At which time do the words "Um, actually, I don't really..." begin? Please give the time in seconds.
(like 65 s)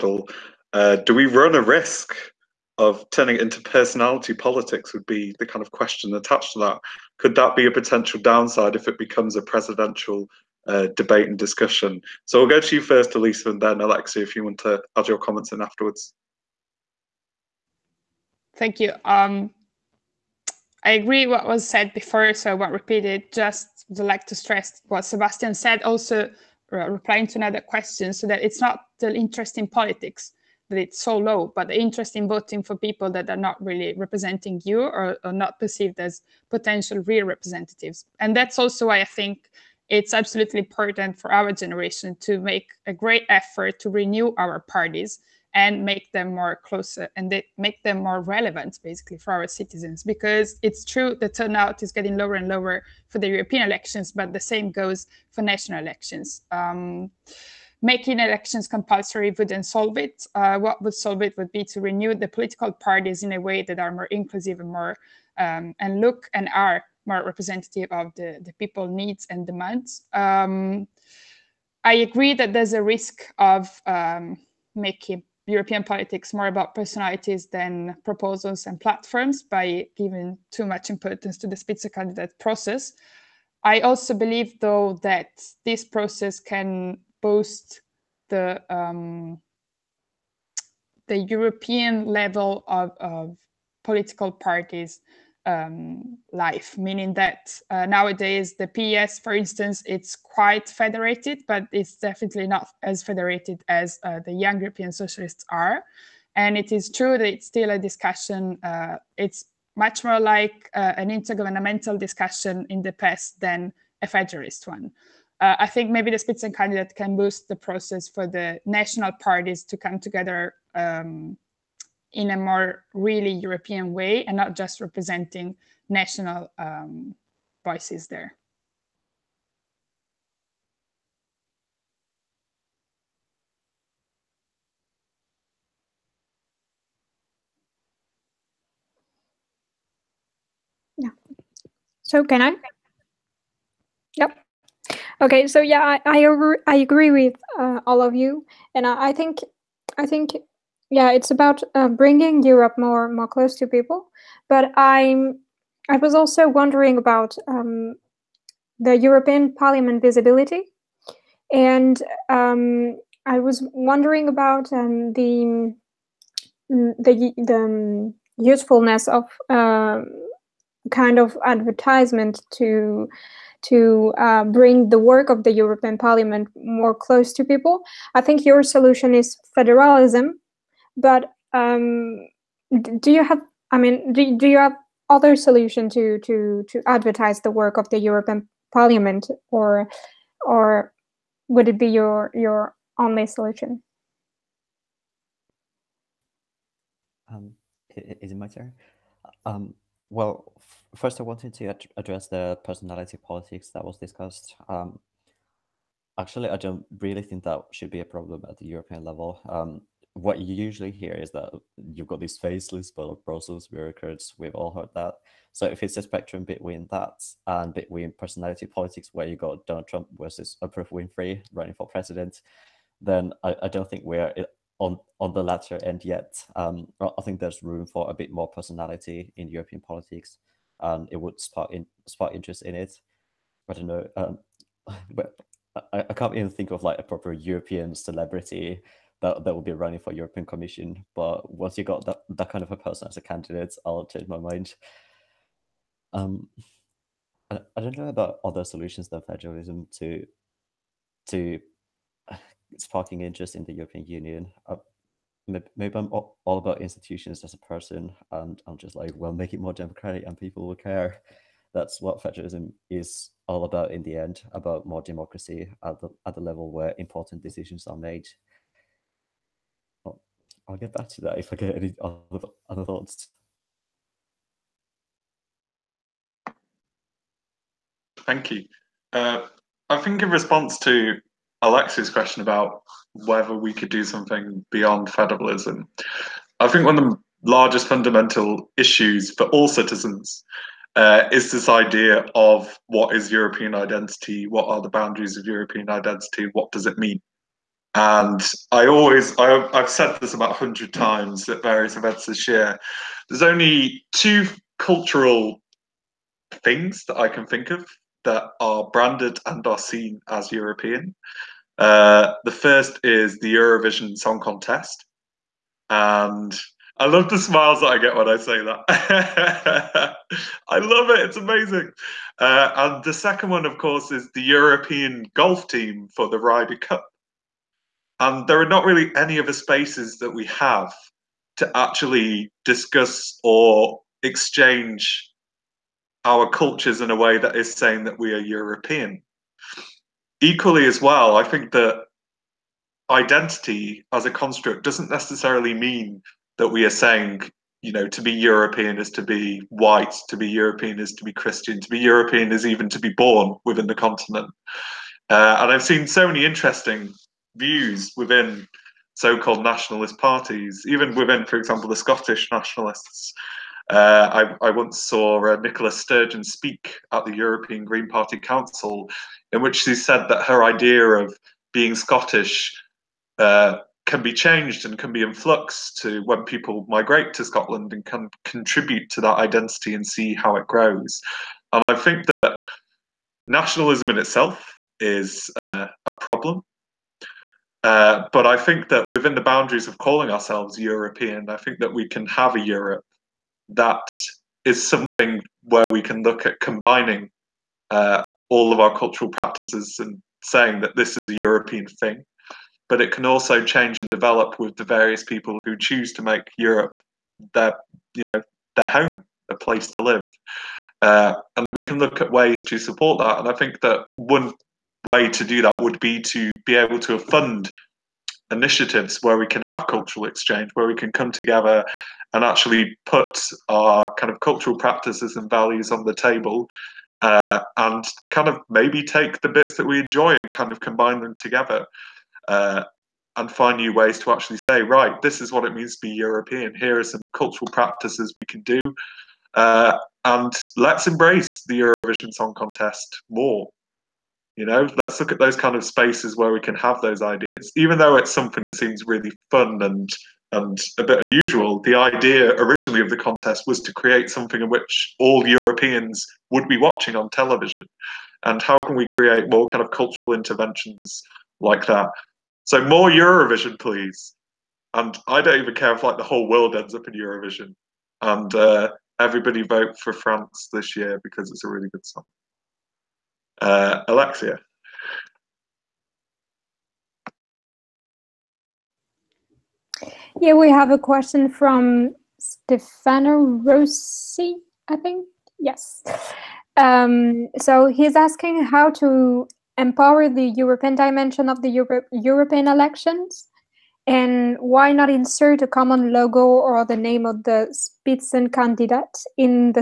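204 s.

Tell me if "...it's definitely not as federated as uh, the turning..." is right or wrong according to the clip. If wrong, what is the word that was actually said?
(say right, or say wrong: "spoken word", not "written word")
wrong: "young", not "turning".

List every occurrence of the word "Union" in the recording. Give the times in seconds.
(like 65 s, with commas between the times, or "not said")
254 s.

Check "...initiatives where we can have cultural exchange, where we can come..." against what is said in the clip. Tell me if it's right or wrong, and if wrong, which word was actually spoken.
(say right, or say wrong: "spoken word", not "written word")
right.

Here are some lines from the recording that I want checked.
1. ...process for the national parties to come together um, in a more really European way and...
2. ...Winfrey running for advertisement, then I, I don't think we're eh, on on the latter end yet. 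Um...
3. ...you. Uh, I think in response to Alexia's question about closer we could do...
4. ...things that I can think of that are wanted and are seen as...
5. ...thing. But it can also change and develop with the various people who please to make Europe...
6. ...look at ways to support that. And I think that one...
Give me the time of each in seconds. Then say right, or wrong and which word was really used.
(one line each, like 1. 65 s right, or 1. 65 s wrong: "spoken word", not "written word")
1. 117 s right
2. 220 s wrong: "president", not "advertisement"
3. 278 s wrong: "whether", not "closer"
4. 306 s wrong: "branded", not "wanted"
5. 401 s wrong: "choose", not "please"
6. 411 s right.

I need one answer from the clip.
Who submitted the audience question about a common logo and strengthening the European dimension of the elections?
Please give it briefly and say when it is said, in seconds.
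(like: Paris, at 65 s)
Stefano Rossi, at 482 s.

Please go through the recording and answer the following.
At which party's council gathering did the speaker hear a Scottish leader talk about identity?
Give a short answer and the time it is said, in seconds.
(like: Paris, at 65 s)
European Green Party, at 367 s.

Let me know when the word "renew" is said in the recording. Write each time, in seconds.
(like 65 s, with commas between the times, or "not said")
43 s, 61 s.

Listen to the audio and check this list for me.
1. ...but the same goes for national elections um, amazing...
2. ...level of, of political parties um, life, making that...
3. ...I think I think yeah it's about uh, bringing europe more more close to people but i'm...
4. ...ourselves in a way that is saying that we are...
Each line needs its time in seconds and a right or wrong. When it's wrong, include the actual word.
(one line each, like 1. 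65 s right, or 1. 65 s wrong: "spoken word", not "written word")
1. 54 s wrong: "making", not "amazing"
2. 92 s wrong: "meaning", not "making"
3. 149 s right
4. 336 s wrong: "cultures", not "ourselves".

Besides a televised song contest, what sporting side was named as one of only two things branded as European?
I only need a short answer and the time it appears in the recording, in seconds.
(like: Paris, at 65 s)
European golf team, at 324 s.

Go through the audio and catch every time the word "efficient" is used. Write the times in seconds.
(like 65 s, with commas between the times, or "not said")
not said.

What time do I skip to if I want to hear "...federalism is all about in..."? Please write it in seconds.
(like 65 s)
262 s.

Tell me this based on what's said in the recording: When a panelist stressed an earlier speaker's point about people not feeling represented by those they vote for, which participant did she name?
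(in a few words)
Sebastian.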